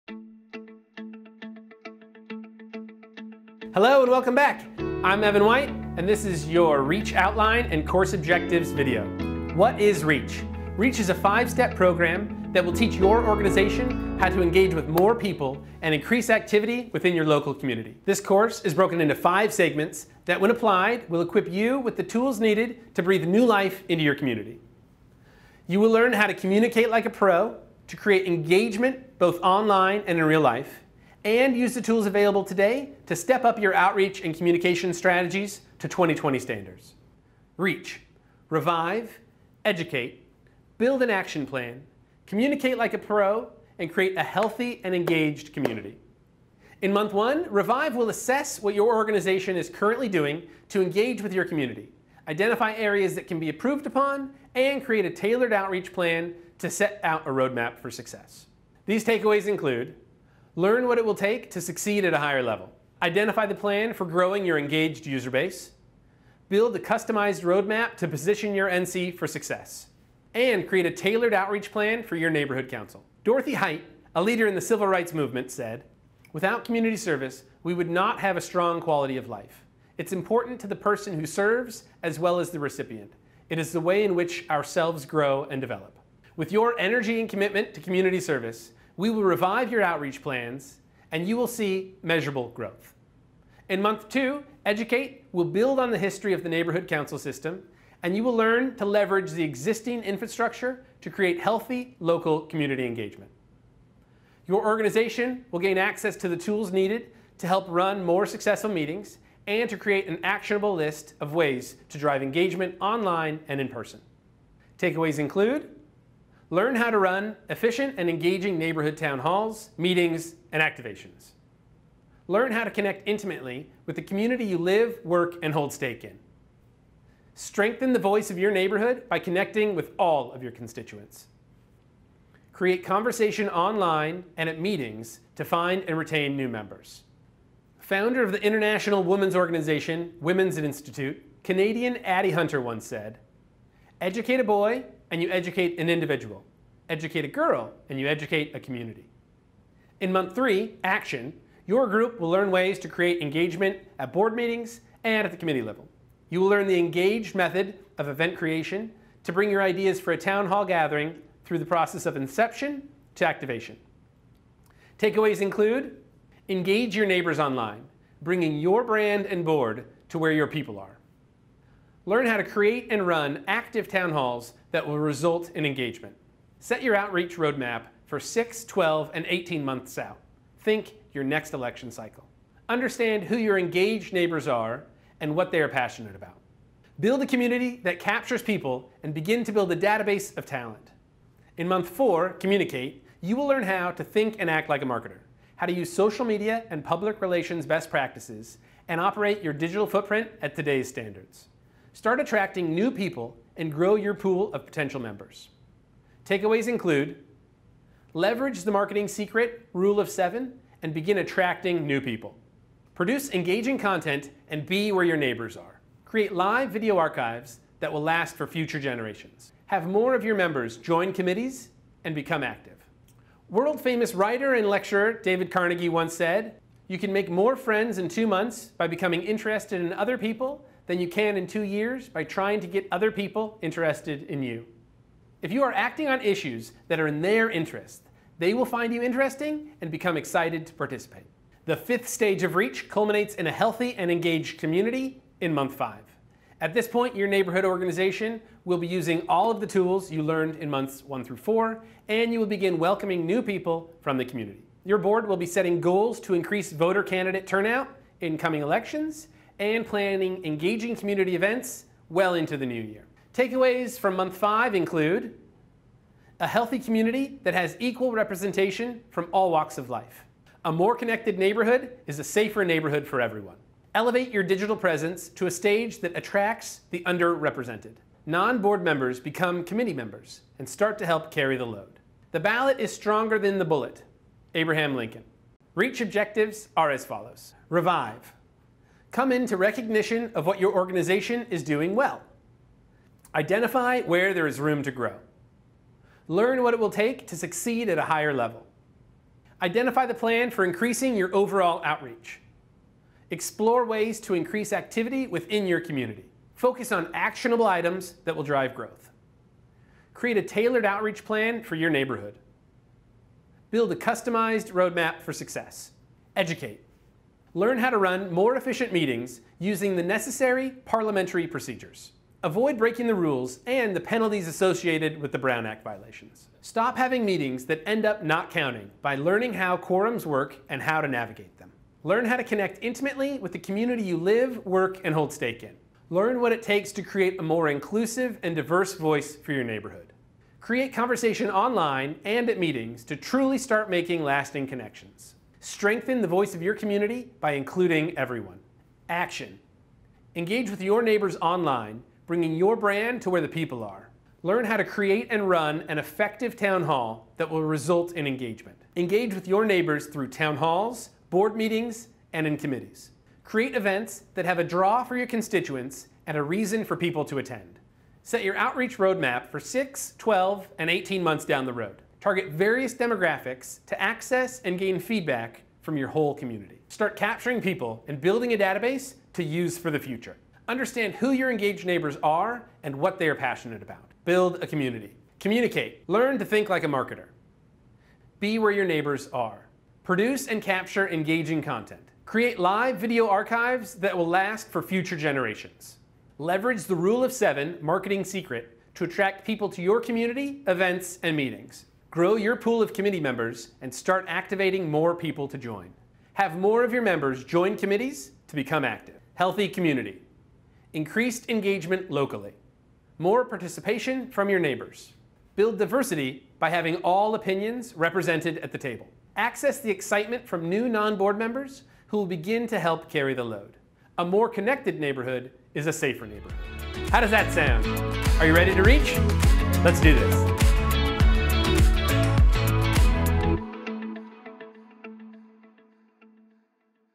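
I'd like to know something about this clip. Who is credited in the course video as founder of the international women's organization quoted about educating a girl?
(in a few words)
Addie Hunter.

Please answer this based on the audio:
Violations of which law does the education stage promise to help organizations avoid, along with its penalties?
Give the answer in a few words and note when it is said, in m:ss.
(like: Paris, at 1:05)
Brown Act, at 5:25.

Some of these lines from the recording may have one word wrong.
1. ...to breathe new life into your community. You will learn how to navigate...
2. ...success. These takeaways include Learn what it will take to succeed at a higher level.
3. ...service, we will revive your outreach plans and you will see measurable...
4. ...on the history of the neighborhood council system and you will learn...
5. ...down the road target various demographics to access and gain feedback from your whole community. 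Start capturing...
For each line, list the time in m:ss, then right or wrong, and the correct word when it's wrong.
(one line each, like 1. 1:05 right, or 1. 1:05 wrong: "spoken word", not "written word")
1. 0:22 wrong: "communicate", not "navigate"
2. 0:57 right
3. 1:28 right
4. 1:35 right
5. 6:11 right.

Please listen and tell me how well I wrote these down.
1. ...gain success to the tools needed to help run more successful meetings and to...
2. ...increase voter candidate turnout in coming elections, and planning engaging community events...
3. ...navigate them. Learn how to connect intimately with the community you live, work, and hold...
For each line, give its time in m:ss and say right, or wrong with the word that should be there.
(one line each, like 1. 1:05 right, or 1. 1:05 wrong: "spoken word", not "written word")
1. 1:45 wrong: "access", not "success"
2. 4:16 right
3. 5:31 right.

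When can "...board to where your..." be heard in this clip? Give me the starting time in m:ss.
2:49.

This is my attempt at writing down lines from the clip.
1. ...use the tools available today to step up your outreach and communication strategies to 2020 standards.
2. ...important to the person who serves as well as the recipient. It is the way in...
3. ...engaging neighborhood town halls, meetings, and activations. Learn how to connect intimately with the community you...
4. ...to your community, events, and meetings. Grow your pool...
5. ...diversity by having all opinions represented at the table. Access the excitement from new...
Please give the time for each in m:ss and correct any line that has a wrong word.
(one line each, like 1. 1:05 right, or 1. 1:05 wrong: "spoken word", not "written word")
1. 0:31 right
2. 1:20 right
3. 1:58 right
4. 6:39 right
5. 6:55 right.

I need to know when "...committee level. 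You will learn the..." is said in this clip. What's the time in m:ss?
2:35.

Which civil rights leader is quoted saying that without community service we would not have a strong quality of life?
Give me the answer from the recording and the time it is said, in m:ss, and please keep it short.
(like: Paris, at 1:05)
Dorothy Height, at 1:13.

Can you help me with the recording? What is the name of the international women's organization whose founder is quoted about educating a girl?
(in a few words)
Women's Institute.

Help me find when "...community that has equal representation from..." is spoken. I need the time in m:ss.
4:26.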